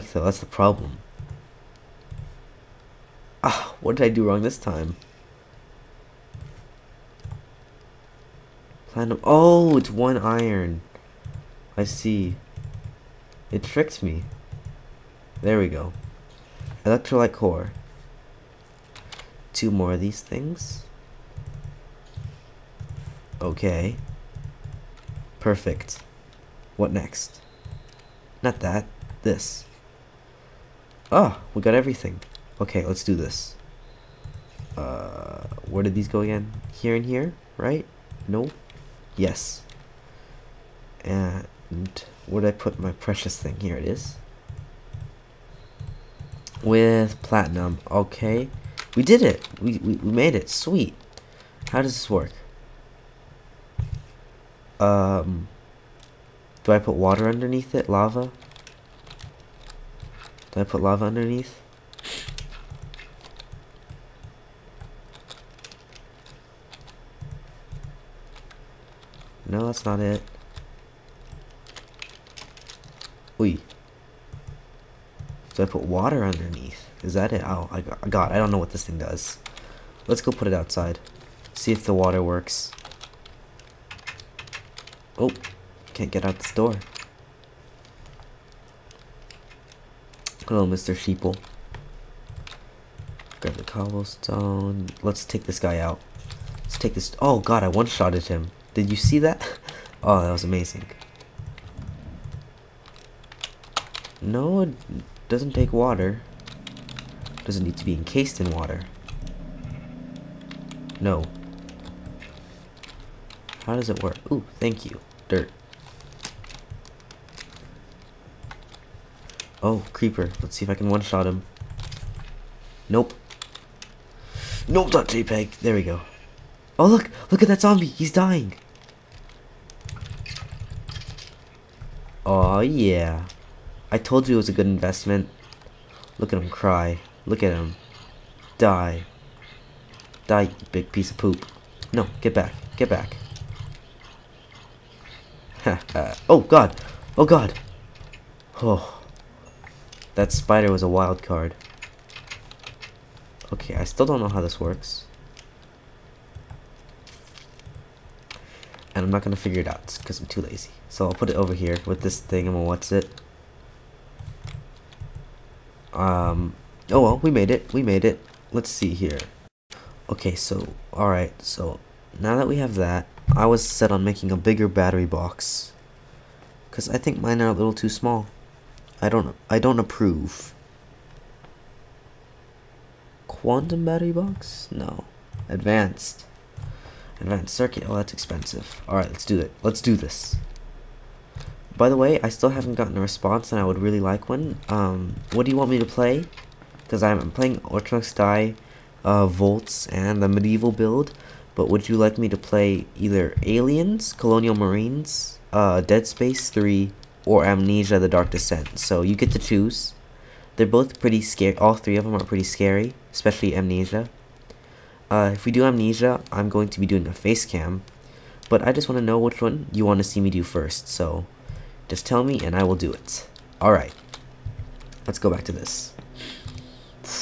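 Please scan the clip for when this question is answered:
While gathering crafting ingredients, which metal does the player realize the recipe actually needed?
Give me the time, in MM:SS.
00:09.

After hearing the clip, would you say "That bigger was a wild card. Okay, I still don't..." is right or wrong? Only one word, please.
wrong.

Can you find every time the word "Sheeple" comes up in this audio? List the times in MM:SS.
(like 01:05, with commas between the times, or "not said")
01:30.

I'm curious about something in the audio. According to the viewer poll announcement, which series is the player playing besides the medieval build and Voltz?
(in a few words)
Ultranox Die.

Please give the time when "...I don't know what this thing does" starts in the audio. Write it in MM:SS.
01:18.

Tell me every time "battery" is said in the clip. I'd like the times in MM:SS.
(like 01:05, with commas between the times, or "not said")
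02:54, 03:03.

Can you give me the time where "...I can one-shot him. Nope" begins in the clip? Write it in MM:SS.
02:00.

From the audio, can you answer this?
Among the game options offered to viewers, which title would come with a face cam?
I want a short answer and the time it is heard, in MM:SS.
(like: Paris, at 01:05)
Amnesia The Dark Descent, at 03:27.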